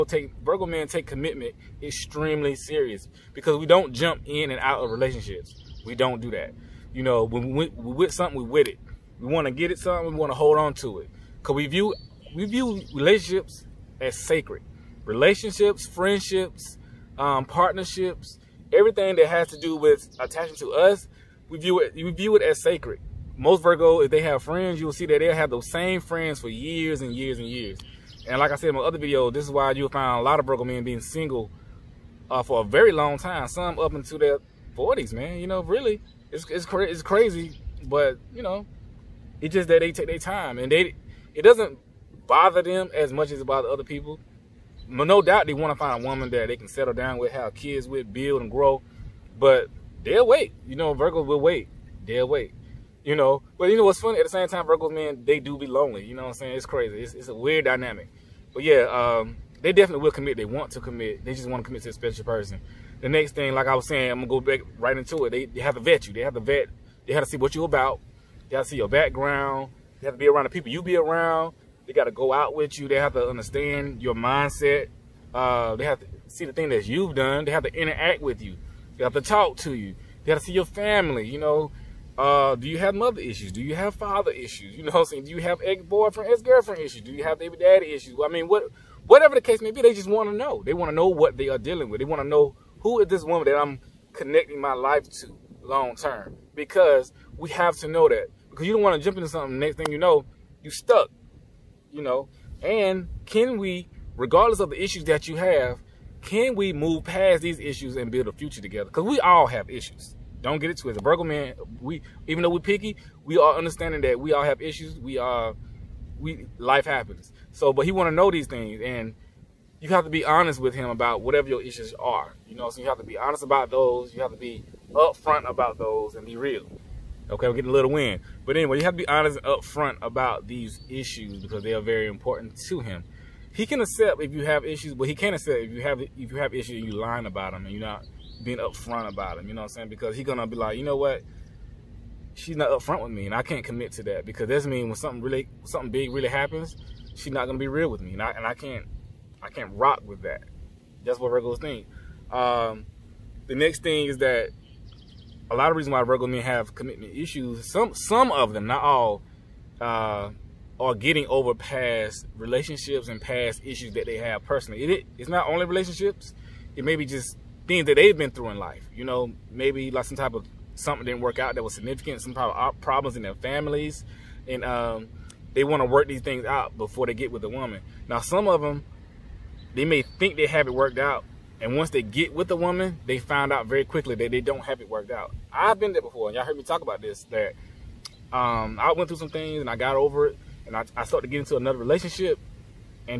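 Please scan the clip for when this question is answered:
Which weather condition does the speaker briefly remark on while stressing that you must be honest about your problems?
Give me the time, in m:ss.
2:07.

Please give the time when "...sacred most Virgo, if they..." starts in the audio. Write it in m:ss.
0:22.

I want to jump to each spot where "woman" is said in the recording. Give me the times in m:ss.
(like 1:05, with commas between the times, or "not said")
0:46, 1:33, 2:57, 3:02.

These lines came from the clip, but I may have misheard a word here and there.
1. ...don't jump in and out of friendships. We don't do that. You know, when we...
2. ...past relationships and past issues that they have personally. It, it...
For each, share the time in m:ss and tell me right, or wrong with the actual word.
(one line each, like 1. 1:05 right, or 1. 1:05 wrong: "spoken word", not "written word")
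1. 0:03 wrong: "relationships", not "friendships"
2. 2:41 right.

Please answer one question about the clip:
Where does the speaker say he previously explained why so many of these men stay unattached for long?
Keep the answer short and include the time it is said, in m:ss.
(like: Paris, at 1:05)
my other video, at 0:28.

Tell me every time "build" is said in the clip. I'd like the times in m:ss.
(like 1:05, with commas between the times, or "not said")
0:48, 1:48.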